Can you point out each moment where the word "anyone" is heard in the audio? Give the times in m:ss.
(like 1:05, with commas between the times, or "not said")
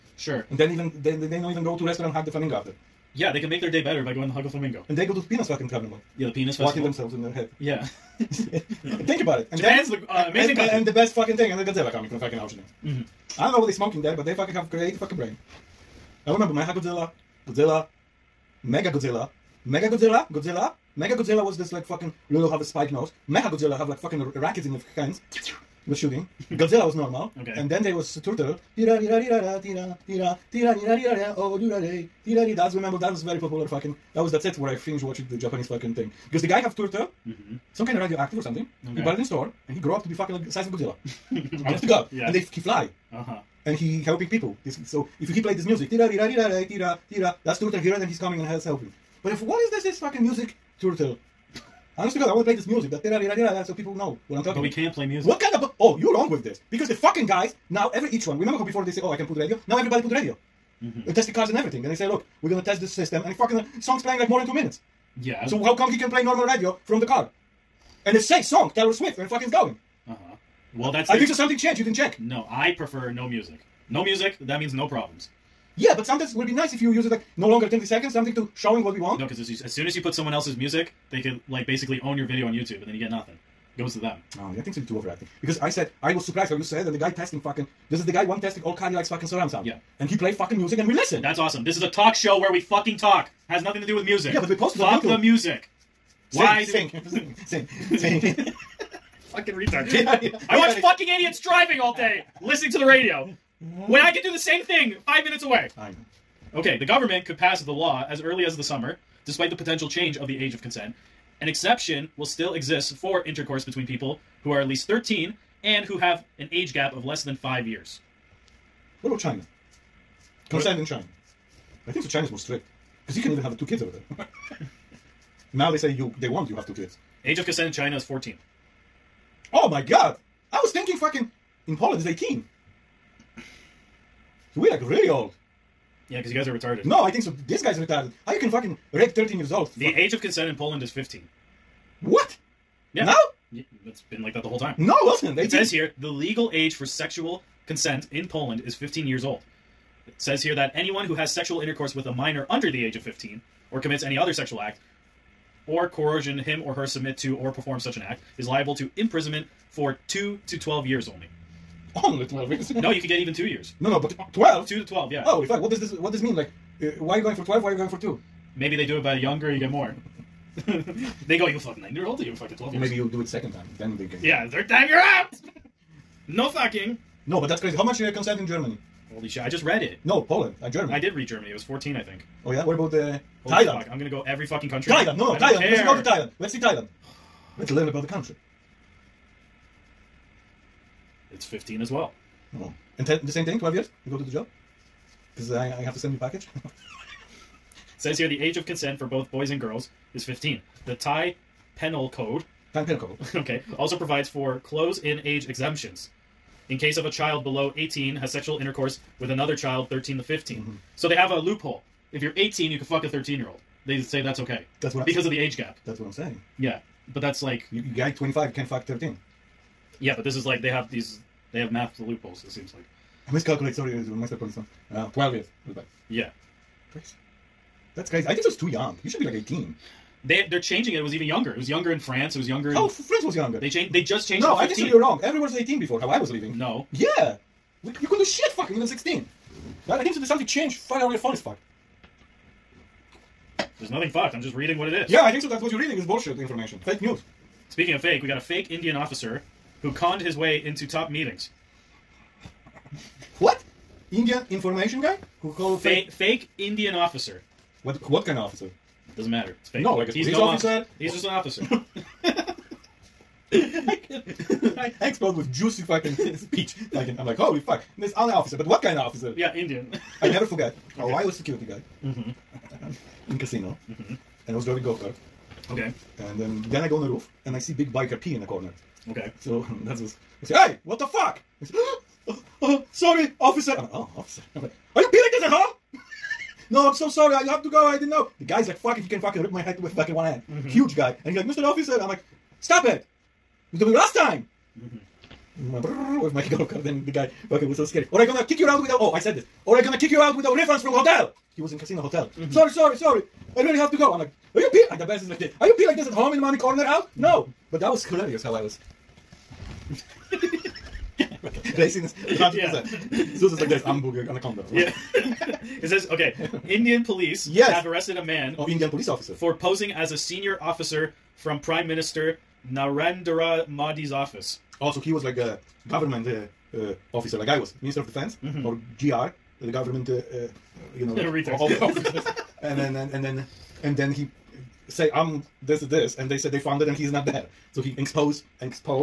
2:30.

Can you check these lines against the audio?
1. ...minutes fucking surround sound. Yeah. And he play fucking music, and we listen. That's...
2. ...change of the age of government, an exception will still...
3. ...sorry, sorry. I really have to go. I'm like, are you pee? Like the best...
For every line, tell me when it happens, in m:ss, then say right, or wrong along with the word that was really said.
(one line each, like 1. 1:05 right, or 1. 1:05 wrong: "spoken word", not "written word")
1. 1:28 wrong: "likes", not "minutes"
2. 1:49 wrong: "consent", not "government"
3. 5:02 right.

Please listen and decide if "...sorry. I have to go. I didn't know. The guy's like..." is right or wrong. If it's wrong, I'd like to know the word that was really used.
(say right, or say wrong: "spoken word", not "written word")
right.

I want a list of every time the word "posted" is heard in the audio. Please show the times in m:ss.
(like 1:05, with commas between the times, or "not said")
1:34.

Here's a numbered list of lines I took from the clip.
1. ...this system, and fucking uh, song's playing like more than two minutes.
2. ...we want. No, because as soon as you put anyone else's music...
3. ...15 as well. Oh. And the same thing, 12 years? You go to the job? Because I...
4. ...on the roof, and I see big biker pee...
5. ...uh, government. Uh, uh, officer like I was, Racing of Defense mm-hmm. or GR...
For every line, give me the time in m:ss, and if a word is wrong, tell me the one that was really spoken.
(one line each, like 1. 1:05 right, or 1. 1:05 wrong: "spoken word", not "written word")
1. 1:02 right
2. 1:18 wrong: "someone", not "anyone"
3. 3:11 right
4. 4:36 right
5. 5:25 wrong: "Minister", not "Racing".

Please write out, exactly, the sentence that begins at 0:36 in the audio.
Because the guy have turtle, mm-hmm.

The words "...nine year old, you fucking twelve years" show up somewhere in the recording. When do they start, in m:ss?
2:51.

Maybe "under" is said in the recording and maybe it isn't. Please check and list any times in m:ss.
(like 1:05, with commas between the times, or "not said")
2:32.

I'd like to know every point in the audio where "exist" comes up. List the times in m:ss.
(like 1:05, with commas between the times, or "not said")
1:52.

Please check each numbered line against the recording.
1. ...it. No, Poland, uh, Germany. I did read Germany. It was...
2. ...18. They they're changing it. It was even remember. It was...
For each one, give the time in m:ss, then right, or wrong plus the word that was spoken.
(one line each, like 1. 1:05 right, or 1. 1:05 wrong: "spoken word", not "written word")
1. 2:59 right
2. 3:49 wrong: "younger", not "remember".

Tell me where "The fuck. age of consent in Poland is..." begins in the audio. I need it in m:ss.
2:19.